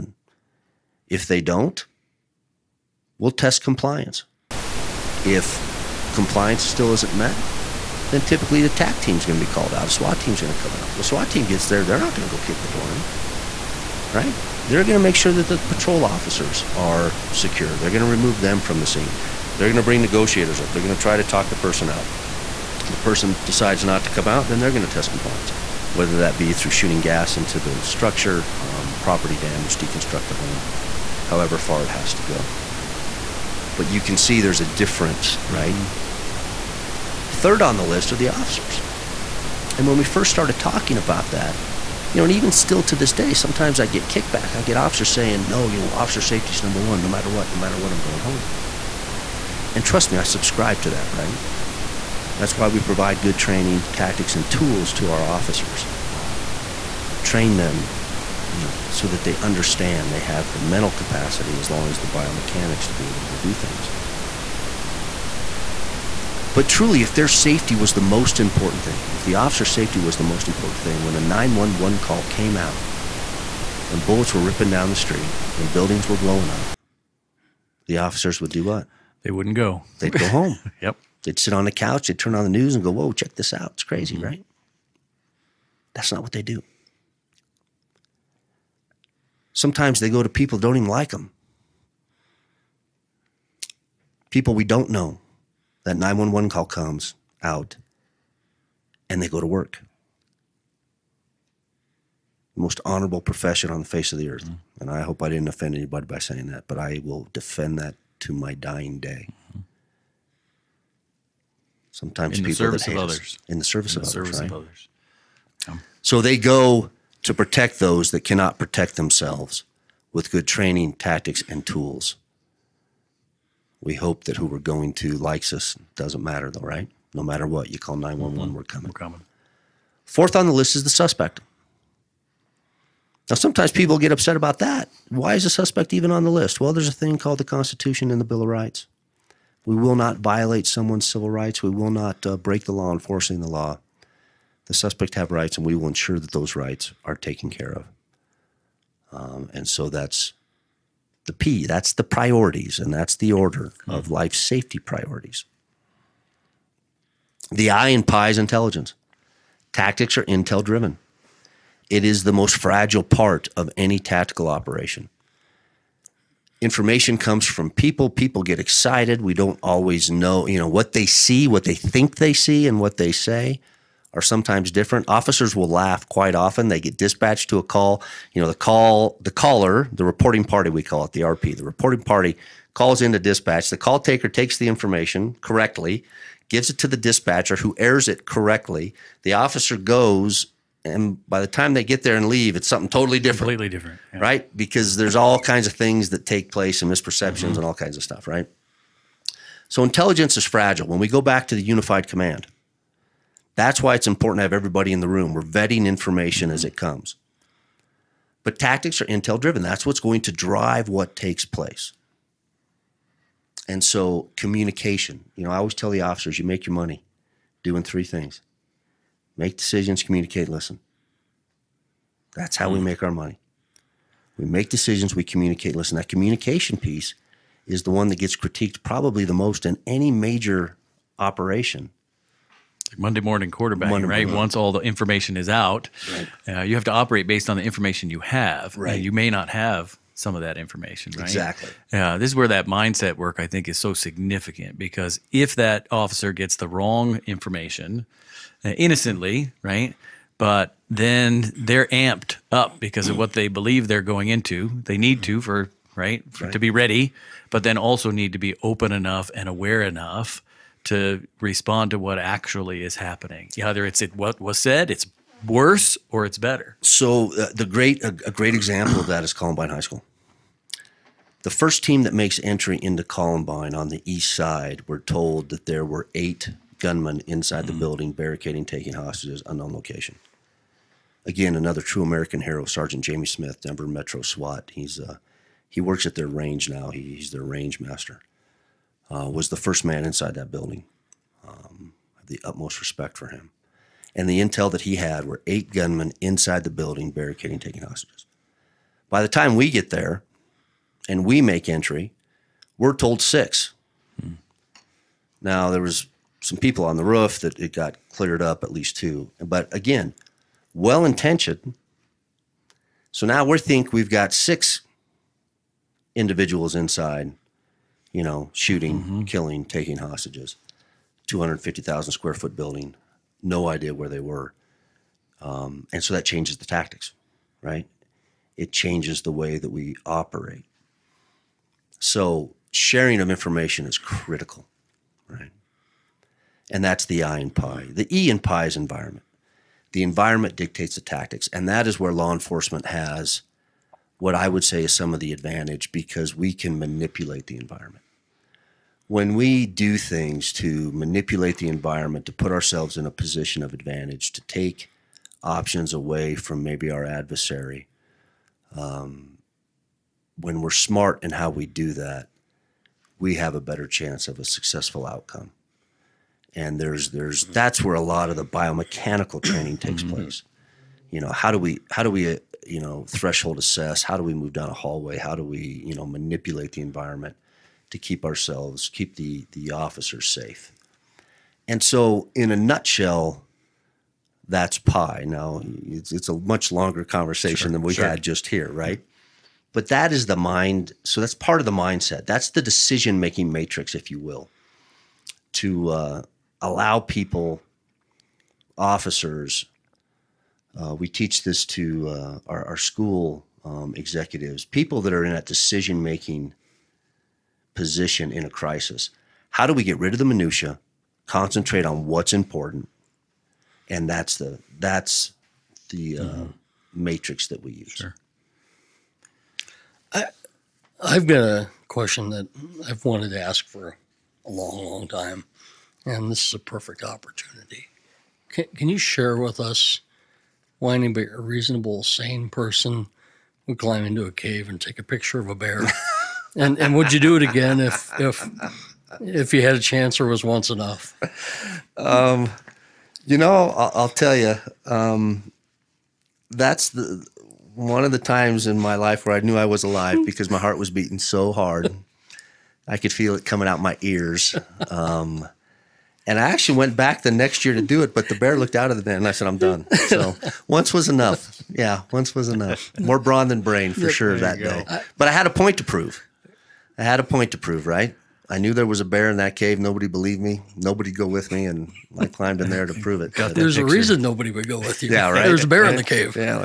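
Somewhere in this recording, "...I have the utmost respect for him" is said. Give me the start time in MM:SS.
04:52.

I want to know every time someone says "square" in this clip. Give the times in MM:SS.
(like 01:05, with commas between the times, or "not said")
05:22.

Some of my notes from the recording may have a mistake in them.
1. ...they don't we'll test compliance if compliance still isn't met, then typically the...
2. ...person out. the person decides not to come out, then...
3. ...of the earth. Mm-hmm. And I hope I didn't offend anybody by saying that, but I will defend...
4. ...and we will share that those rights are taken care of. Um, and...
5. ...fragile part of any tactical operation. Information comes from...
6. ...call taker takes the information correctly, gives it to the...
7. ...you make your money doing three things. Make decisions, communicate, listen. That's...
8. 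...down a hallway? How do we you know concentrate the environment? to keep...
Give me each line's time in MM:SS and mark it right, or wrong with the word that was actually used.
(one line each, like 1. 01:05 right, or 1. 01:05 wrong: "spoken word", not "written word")
1. 00:01 right
2. 00:21 right
3. 01:44 right
4. 02:25 wrong: "ensure", not "share"
5. 02:42 right
6. 03:03 right
7. 03:36 right
8. 06:14 wrong: "manipulate", not "concentrate".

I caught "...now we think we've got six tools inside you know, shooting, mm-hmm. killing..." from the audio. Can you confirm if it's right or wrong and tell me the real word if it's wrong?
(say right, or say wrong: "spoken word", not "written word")
wrong: "individuals", not "tools".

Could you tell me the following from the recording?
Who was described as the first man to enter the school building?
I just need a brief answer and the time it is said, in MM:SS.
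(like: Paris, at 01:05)
Sergeant Jamie Smith, at 04:42.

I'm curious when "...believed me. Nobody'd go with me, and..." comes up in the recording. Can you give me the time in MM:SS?
07:50.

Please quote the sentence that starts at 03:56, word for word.
uh, you have to operate based on the information you have.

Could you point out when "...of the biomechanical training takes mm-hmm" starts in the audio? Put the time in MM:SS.
06:08.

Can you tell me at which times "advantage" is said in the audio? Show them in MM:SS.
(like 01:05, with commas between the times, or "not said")
05:45, 05:53.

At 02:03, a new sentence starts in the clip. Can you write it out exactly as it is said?
We hope that who we're going to likes us.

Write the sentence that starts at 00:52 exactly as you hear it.
That's why we provide good training, tactics, and tools to our officers.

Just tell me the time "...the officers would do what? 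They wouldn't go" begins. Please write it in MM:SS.
01:17.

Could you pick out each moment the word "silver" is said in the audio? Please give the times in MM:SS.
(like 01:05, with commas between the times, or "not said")
not said.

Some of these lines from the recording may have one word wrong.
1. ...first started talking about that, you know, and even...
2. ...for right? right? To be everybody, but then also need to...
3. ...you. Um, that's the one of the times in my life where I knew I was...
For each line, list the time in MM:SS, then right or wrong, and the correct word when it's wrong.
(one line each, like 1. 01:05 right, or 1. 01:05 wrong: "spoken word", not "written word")
1. 00:40 right
2. 04:15 wrong: "ready", not "everybody"
3. 07:24 right.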